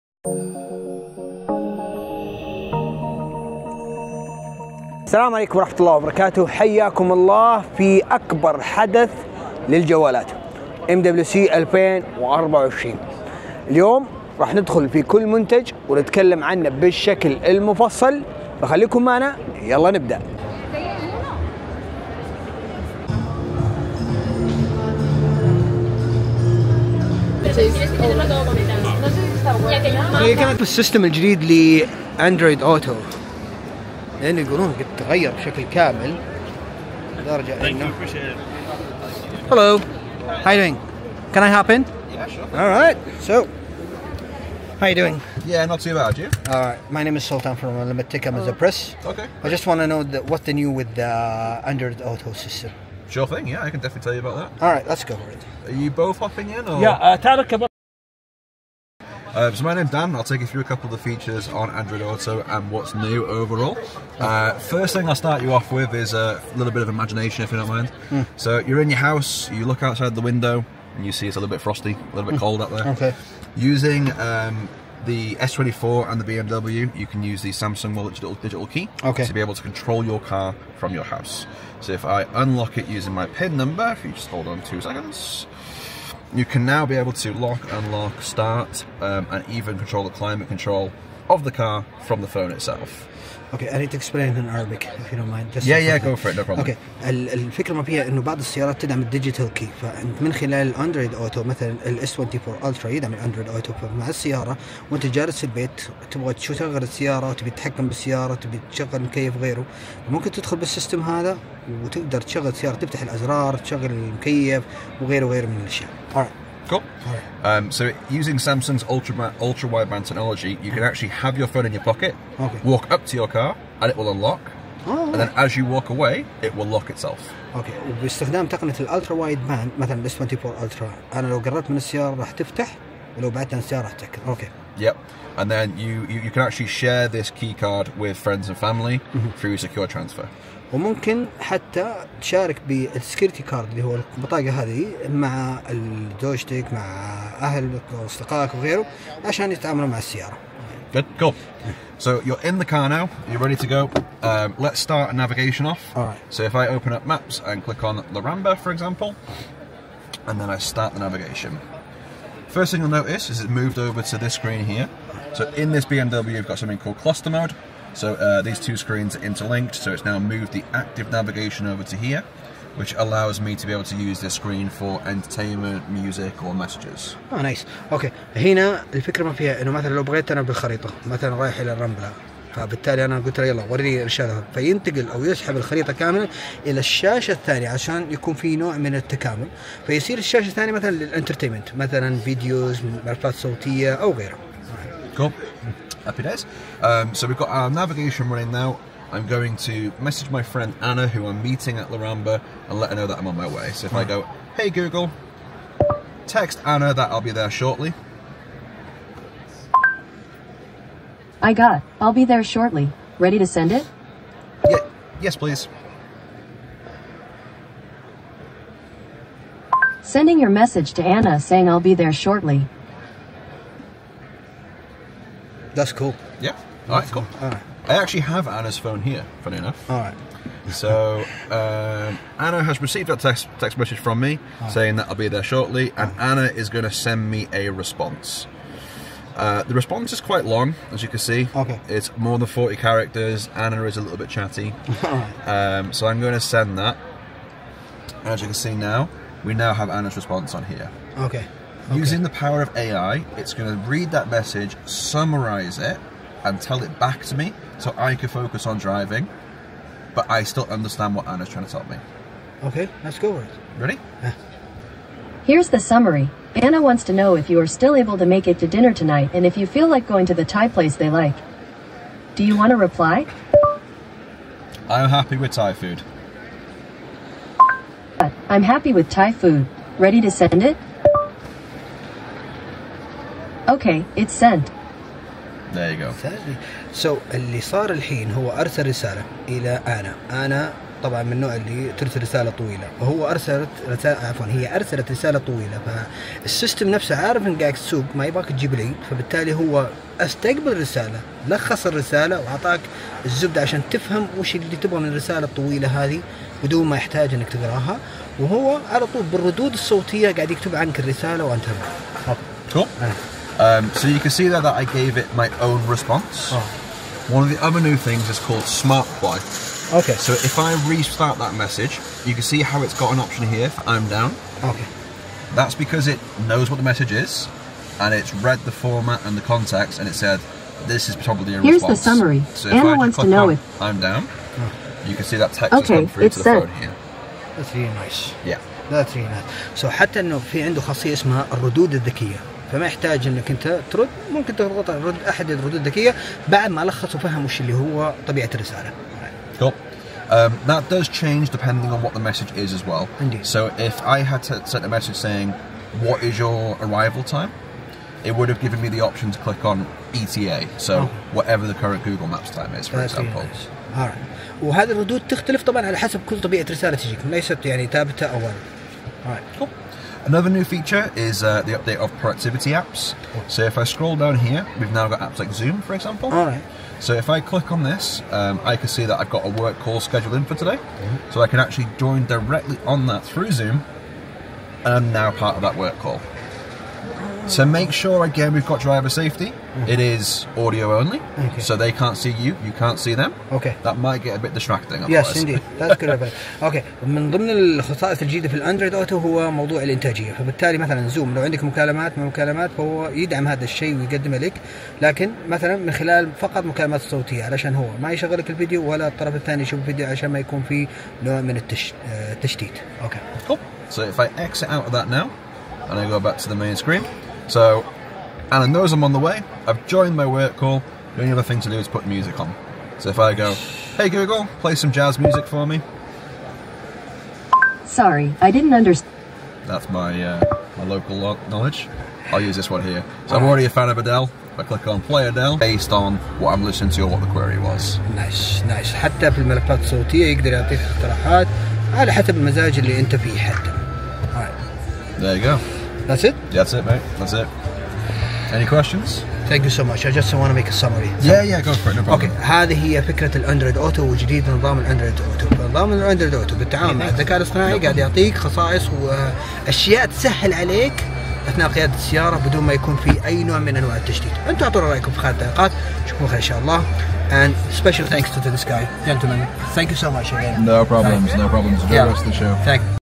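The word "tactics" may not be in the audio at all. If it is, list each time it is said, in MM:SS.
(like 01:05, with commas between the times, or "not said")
not said.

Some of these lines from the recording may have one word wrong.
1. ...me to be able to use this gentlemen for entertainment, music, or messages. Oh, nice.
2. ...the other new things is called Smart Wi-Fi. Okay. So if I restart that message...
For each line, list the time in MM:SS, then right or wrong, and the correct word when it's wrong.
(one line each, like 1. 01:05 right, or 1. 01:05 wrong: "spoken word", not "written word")
1. 02:53 wrong: "screen", not "gentlemen"
2. 05:17 right.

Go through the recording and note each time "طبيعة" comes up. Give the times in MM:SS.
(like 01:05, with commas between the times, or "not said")
05:48, 06:06.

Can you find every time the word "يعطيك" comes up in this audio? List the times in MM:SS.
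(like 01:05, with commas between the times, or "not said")
07:20, 07:37.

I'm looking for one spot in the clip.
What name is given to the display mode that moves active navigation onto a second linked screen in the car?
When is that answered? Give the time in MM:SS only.
02:46.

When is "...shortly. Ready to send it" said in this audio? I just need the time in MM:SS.
03:32.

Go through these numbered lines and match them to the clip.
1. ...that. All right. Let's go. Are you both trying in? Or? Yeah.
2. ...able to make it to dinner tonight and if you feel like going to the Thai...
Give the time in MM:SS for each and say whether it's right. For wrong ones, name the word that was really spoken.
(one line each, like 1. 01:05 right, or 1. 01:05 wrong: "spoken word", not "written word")
1. 00:54 wrong: "hopping", not "trying"
2. 04:27 right.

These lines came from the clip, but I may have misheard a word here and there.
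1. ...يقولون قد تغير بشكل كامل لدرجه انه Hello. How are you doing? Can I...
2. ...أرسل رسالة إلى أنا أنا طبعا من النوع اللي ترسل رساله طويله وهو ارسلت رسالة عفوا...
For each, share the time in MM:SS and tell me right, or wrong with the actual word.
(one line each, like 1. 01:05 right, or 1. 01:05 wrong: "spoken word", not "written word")
1. 00:34 right
2. 04:48 right.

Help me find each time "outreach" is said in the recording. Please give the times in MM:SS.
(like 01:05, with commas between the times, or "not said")
not said.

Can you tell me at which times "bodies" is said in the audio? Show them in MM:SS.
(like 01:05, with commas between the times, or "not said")
not said.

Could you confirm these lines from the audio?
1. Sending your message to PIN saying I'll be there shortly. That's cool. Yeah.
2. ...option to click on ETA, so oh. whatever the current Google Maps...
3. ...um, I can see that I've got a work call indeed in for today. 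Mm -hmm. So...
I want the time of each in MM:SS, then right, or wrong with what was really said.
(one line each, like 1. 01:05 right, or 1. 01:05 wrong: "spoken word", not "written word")
1. 03:40 wrong: "Anna", not "PIN"
2. 05:59 right
3. 06:18 wrong: "scheduled", not "indeed".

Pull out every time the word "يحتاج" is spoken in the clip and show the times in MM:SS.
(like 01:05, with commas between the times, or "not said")
05:06, 05:42.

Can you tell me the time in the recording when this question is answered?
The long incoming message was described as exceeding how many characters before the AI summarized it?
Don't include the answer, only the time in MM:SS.
04:02.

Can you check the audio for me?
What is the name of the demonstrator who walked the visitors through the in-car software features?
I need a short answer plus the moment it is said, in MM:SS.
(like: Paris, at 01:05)
Dan, at 00:59.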